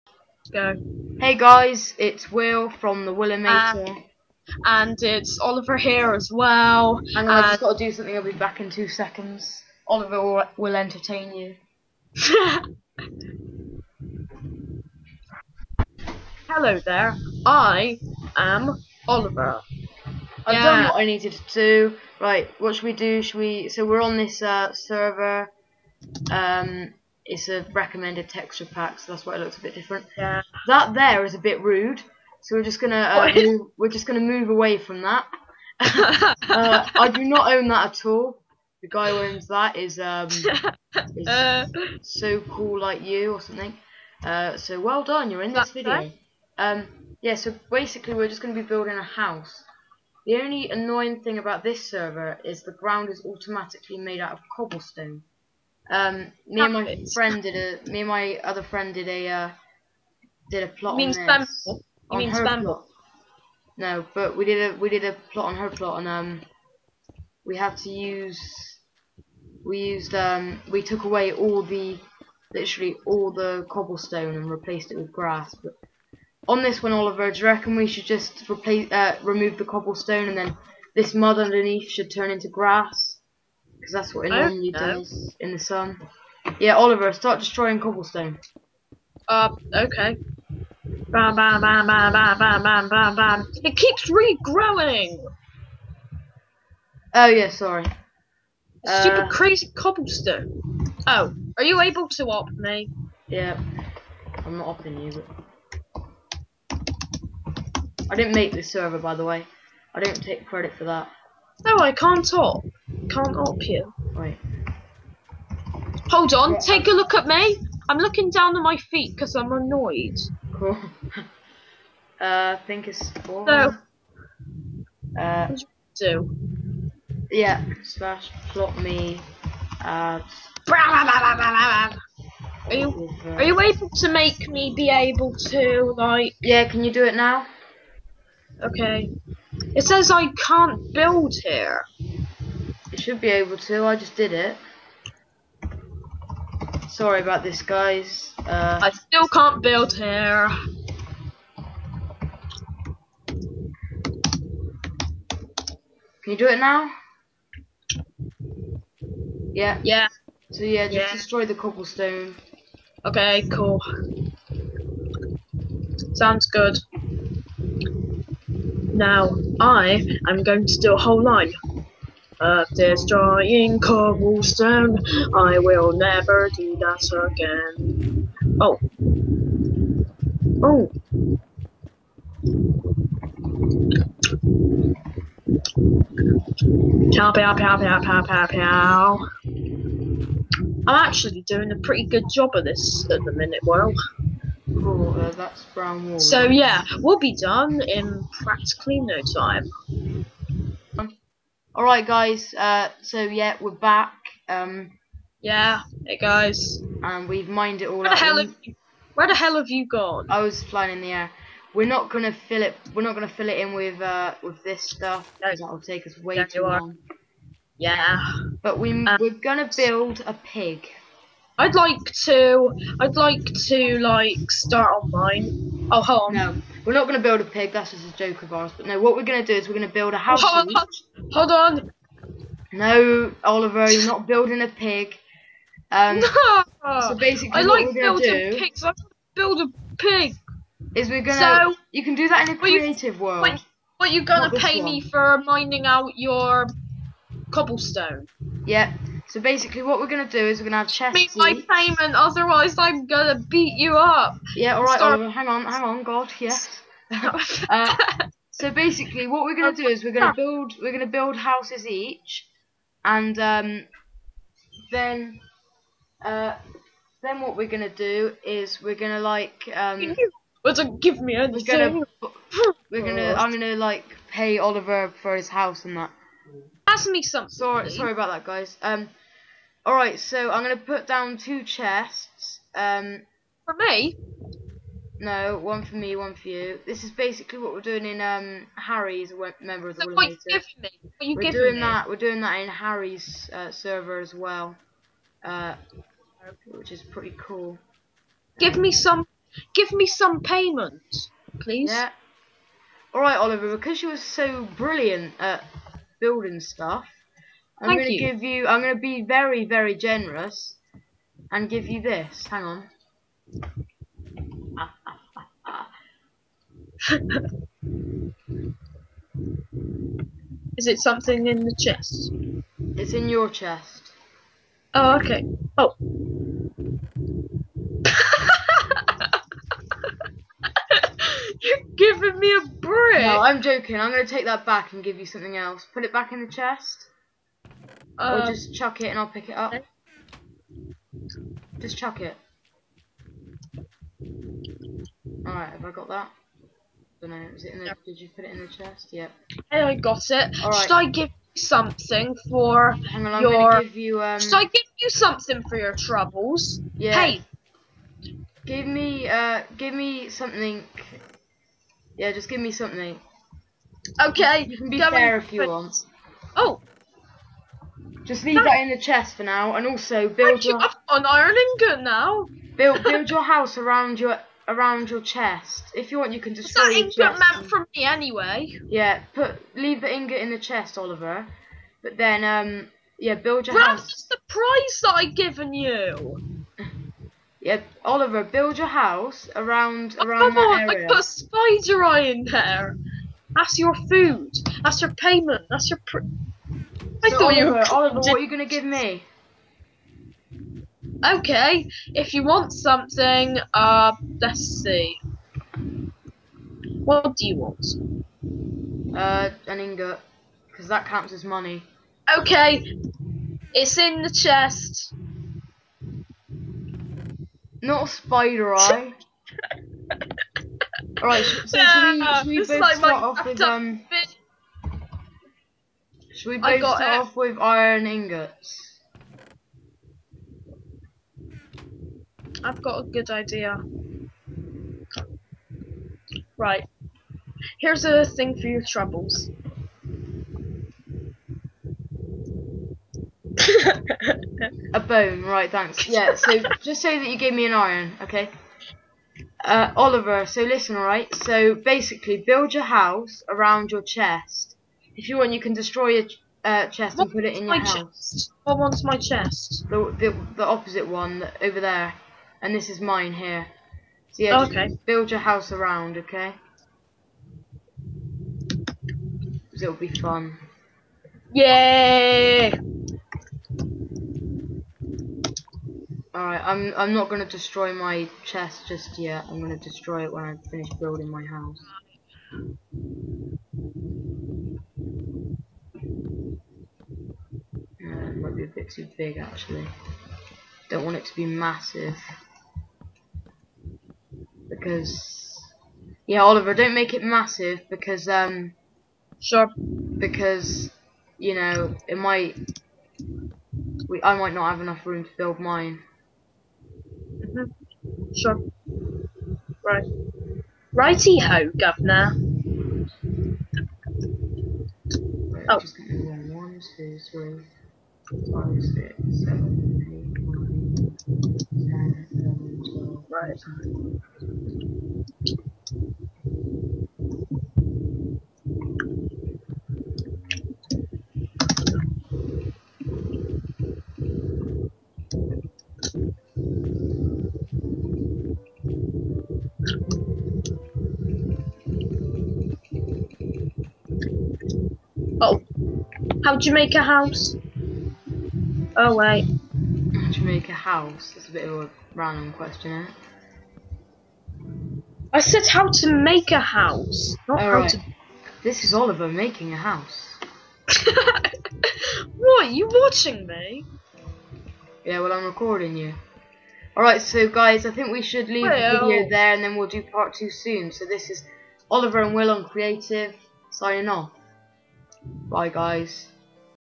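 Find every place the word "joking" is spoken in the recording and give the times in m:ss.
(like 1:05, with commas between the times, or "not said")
5:33.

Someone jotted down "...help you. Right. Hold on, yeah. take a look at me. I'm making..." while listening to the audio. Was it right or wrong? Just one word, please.
wrong.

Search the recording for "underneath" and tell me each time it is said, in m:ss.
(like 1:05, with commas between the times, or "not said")
1:21.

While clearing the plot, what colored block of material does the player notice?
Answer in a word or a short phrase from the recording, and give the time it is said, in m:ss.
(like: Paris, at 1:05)
Brown wool, at 3:15.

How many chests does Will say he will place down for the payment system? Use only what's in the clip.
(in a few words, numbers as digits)
2.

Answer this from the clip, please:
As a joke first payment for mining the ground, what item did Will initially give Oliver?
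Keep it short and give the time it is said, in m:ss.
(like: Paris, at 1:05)
A brick, at 5:32.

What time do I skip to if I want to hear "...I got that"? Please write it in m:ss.
5:45.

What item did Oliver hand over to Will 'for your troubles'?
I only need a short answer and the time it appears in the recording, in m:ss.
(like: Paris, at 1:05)
A bone, at 7:24.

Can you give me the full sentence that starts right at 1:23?
Because that's what it normally does in the sun.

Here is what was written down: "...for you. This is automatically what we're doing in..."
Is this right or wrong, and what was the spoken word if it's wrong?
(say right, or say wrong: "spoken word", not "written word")
wrong: "basically", not "automatically".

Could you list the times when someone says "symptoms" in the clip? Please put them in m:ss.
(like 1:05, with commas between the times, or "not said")
not said.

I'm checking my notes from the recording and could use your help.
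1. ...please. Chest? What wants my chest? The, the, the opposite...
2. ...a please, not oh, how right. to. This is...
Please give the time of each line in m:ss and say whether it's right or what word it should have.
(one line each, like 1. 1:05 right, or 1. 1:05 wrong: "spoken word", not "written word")
1. 7:37 wrong: "house", not "please"
2. 9:16 wrong: "house", not "please".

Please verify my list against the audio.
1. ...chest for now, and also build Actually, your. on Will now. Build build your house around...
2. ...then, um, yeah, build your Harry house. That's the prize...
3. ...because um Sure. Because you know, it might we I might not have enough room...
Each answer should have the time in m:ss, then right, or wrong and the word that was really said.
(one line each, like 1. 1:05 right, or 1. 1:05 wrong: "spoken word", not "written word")
1. 6:08 wrong: "Ireland", not "Will"
2. 6:22 wrong: "Where", not "Harry"
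3. 8:17 right.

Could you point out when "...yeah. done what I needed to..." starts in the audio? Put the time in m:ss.
0:20.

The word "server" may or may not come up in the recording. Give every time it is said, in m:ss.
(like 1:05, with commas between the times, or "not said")
0:24, 0:51, 1:48, 4:53.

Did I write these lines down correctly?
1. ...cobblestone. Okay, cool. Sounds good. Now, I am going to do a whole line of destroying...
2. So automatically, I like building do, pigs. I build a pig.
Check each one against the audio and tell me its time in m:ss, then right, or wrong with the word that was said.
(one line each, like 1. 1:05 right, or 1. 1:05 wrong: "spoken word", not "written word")
1. 2:41 right
2. 3:57 wrong: "basically", not "automatically".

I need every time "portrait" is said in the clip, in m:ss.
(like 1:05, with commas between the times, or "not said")
not said.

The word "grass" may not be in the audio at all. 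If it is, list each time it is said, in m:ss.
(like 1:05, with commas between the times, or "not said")
1:15, 1:22.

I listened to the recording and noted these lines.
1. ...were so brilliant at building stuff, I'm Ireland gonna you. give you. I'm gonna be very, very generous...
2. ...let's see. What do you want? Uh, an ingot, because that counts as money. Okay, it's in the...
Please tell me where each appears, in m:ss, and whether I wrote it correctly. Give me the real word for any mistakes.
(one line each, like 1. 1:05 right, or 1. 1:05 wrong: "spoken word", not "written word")
1. 5:04 wrong: "Thank", not "Ireland"
2. 6:44 right.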